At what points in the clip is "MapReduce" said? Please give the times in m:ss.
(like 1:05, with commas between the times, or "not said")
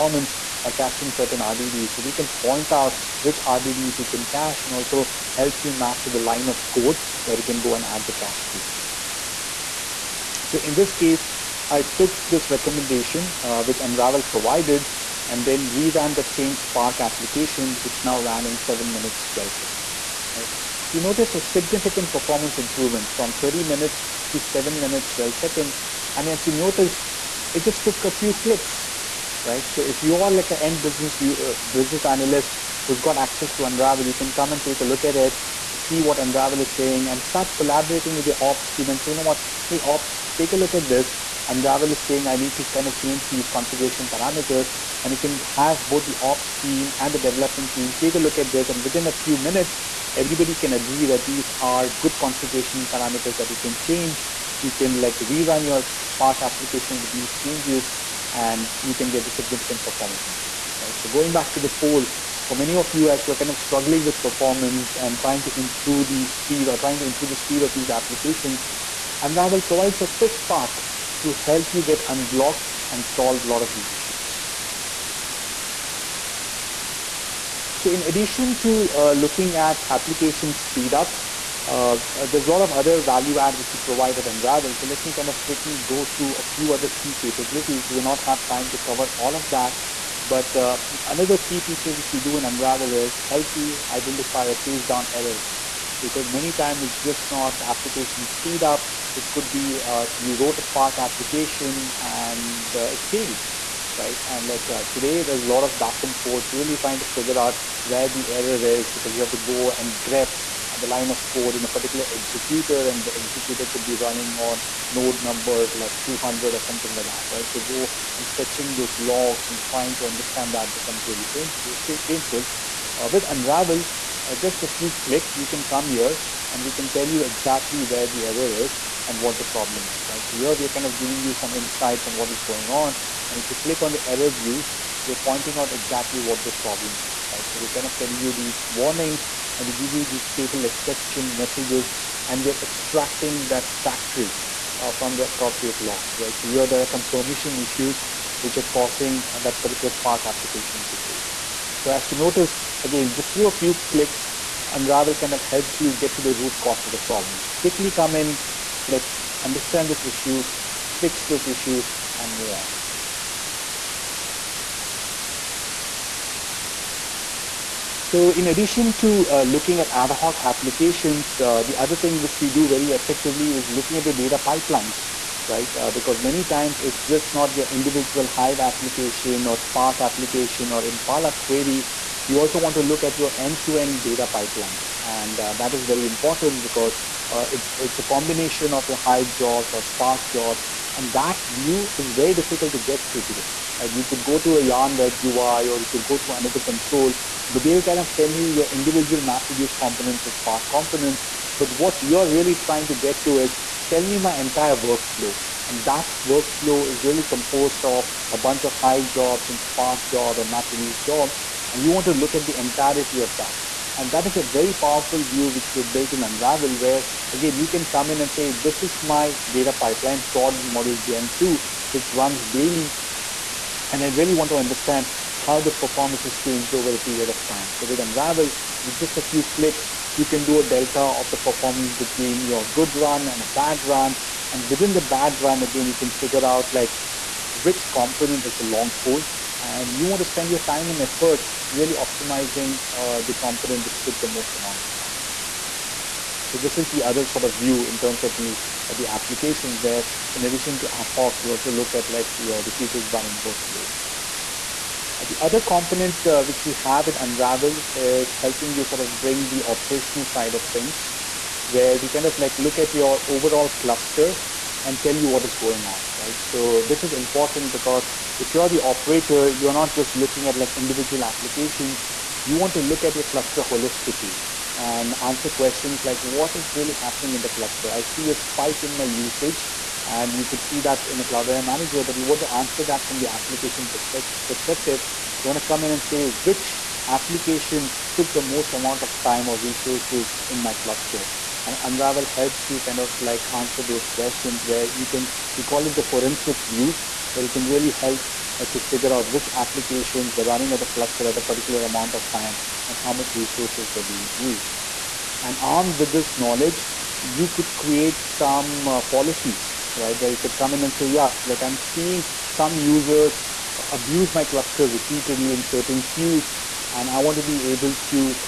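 3:19, 3:30.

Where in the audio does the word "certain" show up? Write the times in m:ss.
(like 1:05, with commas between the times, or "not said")
0:01, 5:15.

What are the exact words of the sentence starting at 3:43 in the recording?
And I really want to understand how the performance has changed over a period of time.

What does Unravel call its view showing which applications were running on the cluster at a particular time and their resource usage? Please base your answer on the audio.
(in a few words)
forensic view.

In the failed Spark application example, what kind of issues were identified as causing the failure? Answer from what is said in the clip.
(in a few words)
permission issues.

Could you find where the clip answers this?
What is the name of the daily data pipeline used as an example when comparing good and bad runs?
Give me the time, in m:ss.
3:40.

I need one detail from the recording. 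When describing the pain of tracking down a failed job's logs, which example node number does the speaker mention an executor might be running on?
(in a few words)
200.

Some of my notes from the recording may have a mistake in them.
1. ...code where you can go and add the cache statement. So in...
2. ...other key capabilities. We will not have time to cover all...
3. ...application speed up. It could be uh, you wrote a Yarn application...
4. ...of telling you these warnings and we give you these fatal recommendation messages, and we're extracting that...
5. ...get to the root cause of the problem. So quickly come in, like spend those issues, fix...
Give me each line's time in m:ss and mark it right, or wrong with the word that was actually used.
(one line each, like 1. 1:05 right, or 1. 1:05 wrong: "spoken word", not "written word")
1. 0:06 right
2. 1:26 right
3. 1:37 wrong: "Spark", not "Yarn"
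4. 2:17 wrong: "exception", not "recommendation"
5. 2:35 wrong: "understand", not "spend".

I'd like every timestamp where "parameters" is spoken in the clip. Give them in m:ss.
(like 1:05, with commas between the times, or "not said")
0:44, 0:52.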